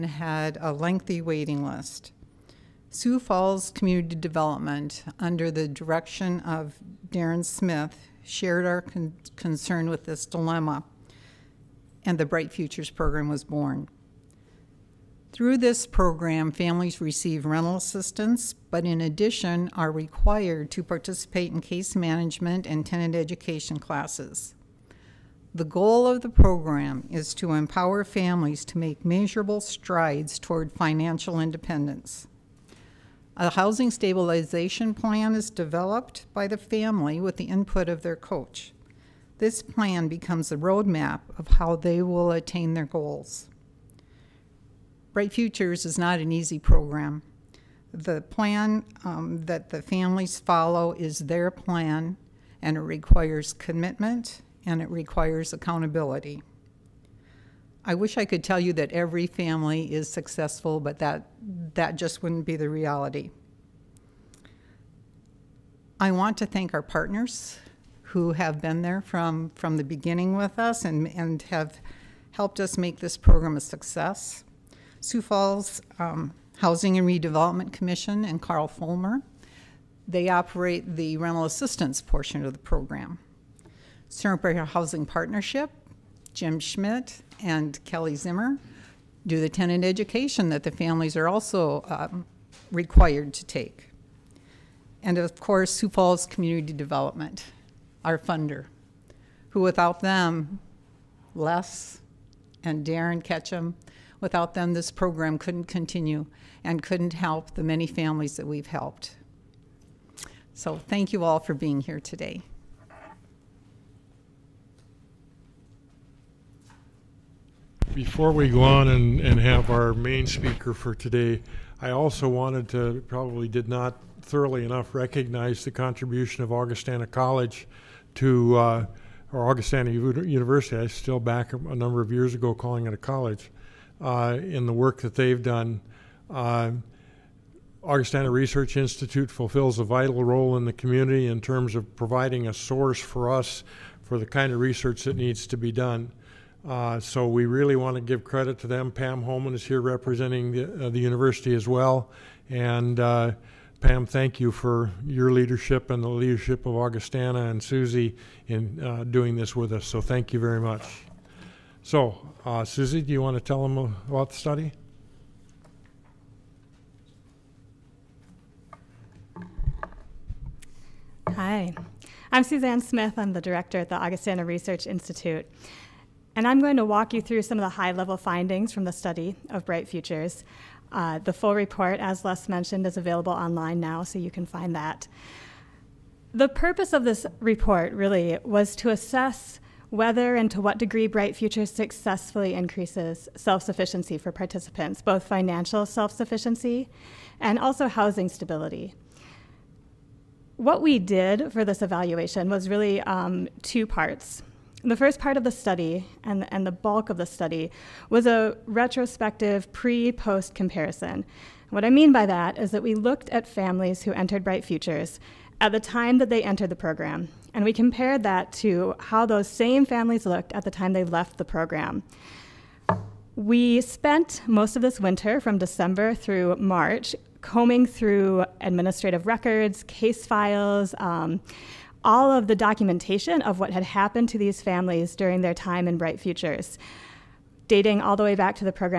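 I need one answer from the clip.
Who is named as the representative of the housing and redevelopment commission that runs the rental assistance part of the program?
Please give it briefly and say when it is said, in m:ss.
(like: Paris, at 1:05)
Carl Fulmer, at 1:18.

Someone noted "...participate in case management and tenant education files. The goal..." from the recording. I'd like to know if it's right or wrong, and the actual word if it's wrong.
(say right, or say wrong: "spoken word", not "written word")
wrong: "classes", not "files".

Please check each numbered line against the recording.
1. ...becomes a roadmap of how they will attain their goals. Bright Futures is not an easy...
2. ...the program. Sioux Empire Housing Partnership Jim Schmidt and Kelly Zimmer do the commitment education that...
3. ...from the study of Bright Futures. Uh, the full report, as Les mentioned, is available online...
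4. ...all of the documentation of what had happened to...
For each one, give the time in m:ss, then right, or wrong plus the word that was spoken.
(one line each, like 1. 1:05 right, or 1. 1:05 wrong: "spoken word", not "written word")
1. 0:40 right
2. 1:22 wrong: "tenant", not "commitment"
3. 2:58 right
4. 3:52 right.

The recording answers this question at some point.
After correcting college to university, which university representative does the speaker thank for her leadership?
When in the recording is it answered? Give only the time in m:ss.
2:28.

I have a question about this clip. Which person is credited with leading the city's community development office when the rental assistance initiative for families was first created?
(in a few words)
Darren Smith.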